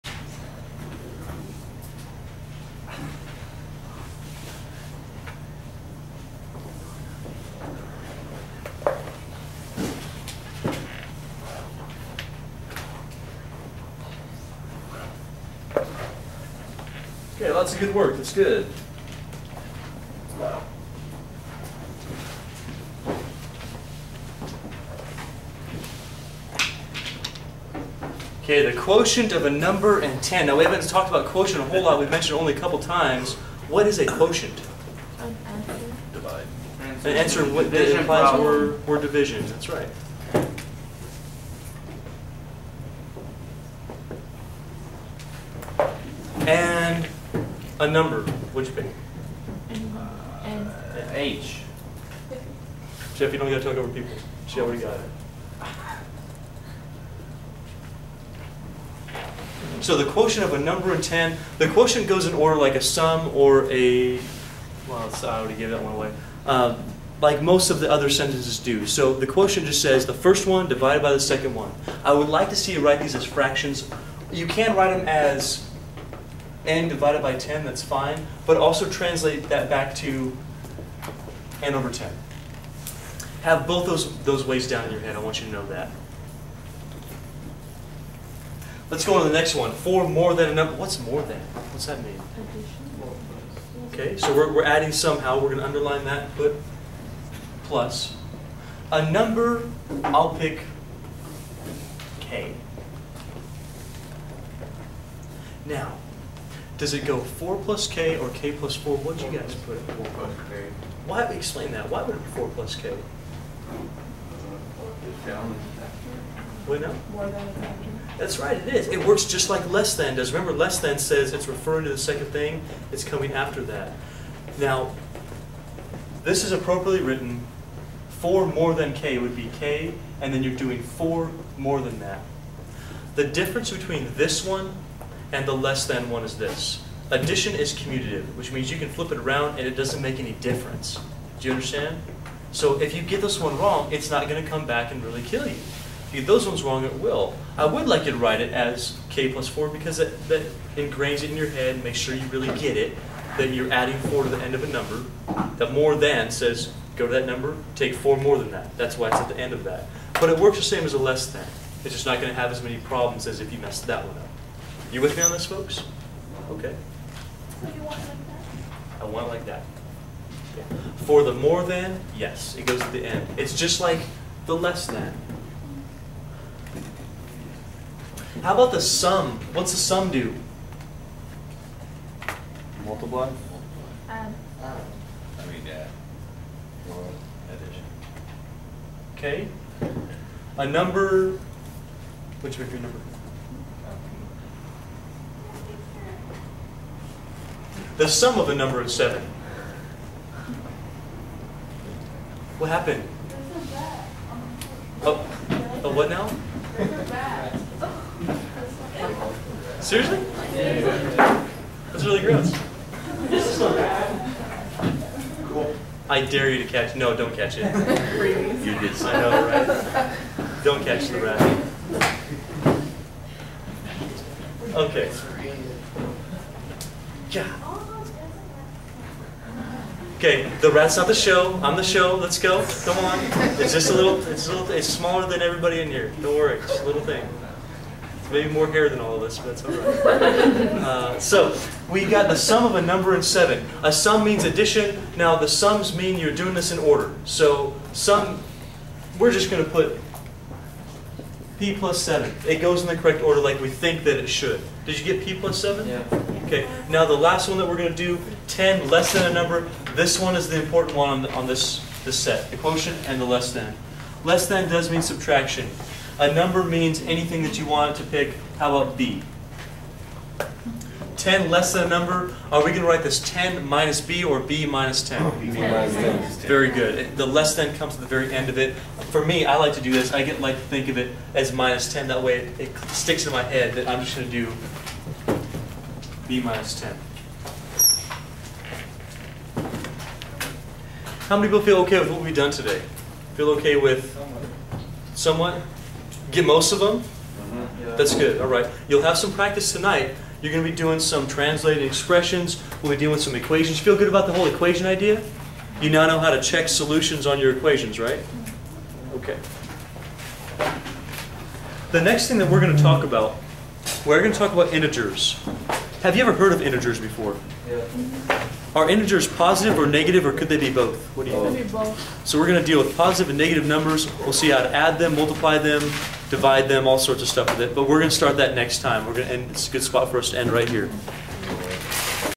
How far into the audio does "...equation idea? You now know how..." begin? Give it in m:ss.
5:04.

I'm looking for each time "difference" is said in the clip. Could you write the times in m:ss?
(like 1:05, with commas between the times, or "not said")
2:13, 2:20.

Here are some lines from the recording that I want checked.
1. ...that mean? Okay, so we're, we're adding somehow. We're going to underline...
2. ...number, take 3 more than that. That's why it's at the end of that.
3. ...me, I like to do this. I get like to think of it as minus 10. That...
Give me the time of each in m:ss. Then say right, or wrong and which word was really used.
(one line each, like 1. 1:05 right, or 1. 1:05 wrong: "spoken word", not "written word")
1. 1:31 right
2. 2:37 wrong: "4", not "3"
3. 4:39 right.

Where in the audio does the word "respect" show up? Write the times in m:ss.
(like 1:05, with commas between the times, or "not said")
not said.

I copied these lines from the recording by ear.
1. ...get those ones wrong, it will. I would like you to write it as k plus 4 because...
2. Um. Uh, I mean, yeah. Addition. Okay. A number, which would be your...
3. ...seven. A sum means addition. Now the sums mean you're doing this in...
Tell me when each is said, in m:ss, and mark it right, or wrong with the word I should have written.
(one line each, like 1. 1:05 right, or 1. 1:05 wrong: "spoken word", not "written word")
1. 2:26 right
2. 3:04 right
3. 4:03 right.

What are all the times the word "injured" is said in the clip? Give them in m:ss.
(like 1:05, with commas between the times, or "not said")
not said.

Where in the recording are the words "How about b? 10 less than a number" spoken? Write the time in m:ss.
4:28.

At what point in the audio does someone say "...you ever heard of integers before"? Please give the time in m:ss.
5:16.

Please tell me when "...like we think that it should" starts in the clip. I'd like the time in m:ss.
4:13.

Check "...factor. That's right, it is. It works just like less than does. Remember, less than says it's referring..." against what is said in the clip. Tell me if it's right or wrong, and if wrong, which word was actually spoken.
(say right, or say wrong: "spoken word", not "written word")
right.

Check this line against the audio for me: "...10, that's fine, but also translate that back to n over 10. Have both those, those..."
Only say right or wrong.
right.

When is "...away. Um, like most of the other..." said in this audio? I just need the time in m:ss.
1:05.